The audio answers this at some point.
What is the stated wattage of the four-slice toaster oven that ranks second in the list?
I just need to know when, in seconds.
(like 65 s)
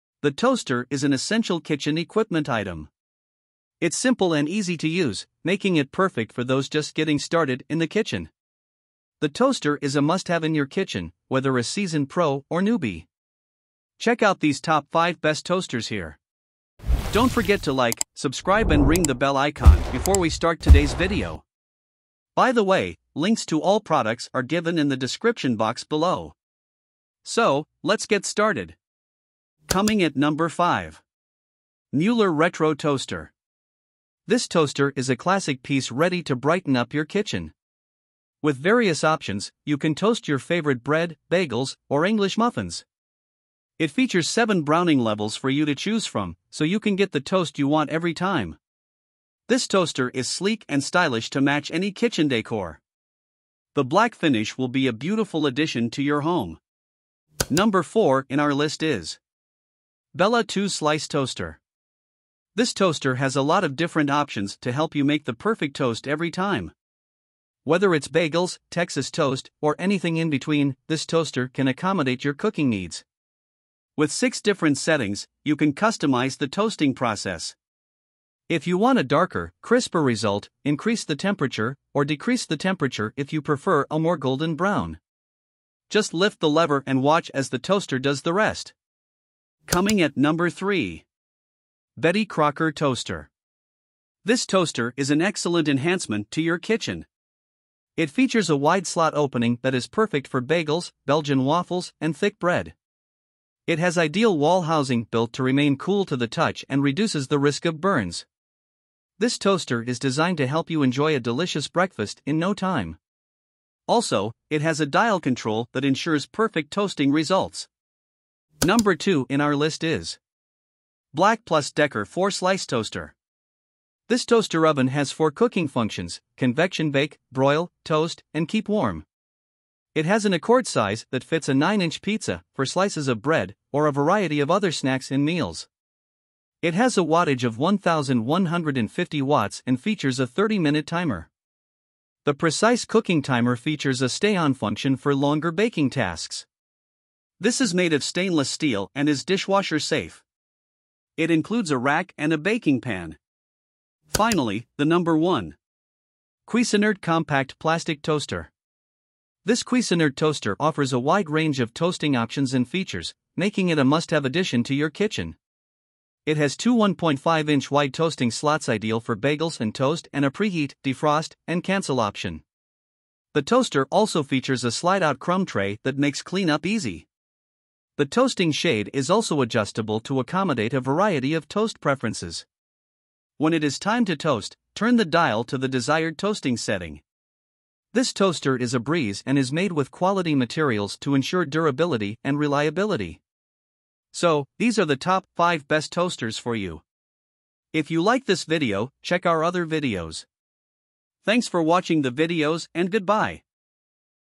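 137 s.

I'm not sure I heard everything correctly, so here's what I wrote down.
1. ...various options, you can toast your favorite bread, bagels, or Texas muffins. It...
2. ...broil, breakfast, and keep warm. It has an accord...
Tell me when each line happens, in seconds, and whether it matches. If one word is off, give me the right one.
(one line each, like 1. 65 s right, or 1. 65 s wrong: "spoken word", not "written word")
1. 38 s wrong: "English", not "Texas"
2. 127 s wrong: "toast", not "breakfast".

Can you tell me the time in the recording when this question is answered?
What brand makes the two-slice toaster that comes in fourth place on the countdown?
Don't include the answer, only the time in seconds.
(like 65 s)
60 s.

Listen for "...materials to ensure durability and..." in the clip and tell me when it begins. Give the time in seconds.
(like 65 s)
190 s.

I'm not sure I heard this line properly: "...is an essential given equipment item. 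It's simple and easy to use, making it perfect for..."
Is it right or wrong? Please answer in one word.
wrong.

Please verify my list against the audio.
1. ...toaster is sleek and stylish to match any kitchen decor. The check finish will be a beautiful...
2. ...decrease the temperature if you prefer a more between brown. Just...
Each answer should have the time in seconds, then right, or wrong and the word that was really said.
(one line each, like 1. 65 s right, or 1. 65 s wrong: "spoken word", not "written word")
1. 49 s wrong: "black", not "check"
2. 82 s wrong: "golden", not "between".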